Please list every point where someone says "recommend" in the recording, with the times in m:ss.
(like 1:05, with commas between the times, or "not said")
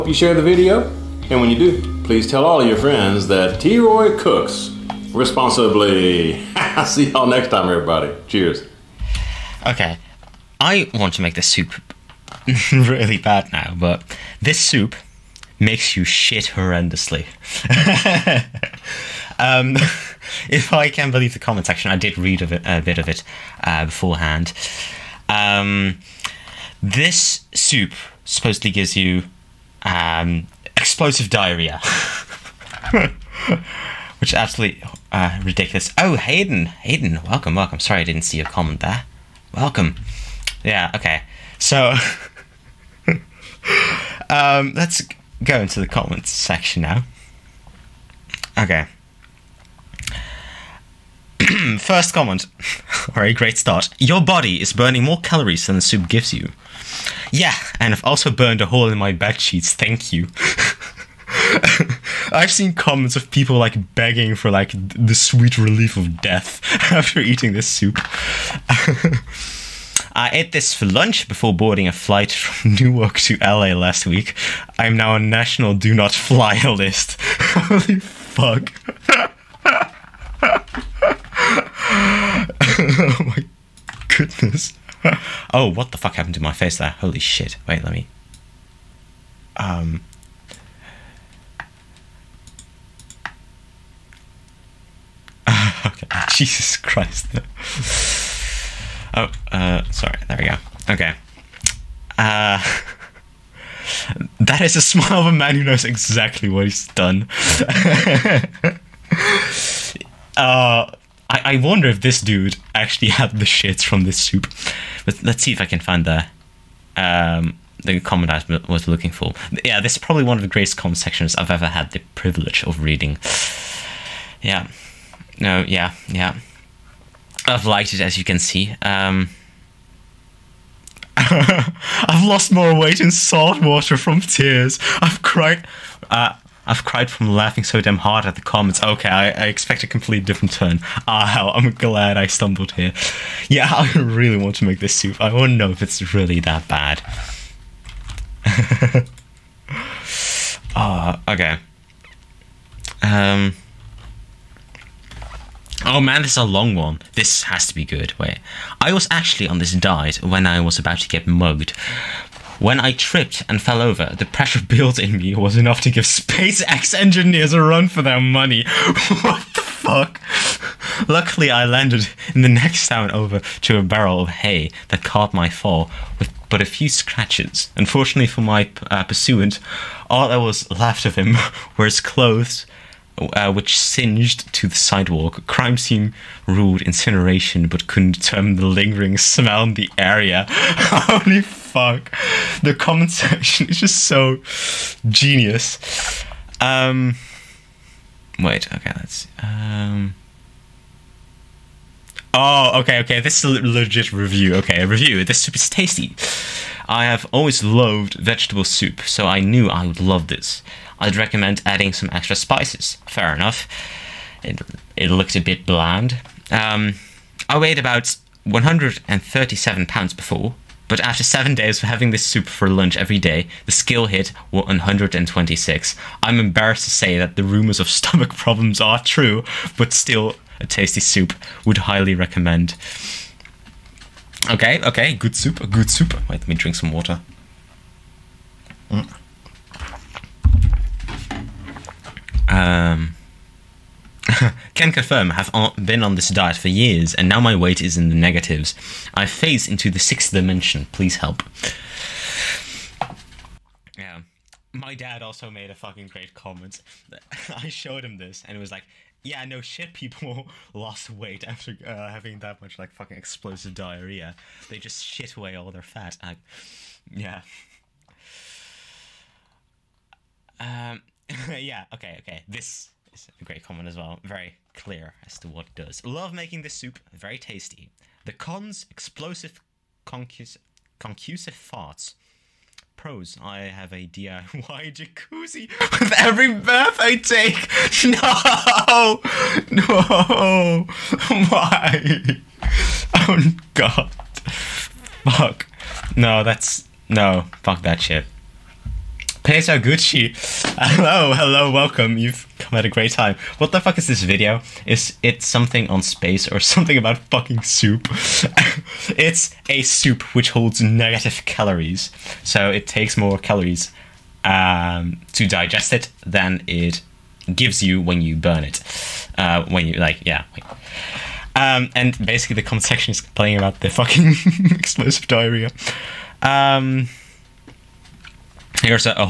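3:31, 3:52.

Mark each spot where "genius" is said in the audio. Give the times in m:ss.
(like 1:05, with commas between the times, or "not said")
3:15.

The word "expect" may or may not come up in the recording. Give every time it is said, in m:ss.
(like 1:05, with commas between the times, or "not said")
2:19.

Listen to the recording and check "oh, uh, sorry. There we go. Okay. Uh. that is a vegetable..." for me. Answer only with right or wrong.
wrong.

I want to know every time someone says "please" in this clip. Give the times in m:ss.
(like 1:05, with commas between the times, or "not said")
0:02, 4:10.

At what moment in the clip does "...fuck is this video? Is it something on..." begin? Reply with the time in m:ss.
5:03.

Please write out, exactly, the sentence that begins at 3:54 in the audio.
Okay, okay, good soup, good soup.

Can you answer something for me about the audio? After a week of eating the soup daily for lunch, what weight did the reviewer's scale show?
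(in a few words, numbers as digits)
126.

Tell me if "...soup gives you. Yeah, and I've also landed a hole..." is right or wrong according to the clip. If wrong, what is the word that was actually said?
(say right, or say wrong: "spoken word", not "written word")
wrong: "burned", not "landed".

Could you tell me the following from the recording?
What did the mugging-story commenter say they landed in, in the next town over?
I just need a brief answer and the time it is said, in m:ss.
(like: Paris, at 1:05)
a barrel of hay, at 2:53.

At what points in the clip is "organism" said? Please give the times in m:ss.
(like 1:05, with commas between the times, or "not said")
not said.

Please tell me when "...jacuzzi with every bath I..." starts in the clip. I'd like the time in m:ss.
4:44.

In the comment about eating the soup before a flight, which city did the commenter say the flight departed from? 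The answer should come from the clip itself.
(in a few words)
Newark.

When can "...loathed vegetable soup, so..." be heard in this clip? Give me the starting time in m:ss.
3:27.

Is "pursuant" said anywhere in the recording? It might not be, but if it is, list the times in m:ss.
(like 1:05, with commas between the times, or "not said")
2:59.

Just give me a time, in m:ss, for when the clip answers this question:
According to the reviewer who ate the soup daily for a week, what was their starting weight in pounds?
3:38.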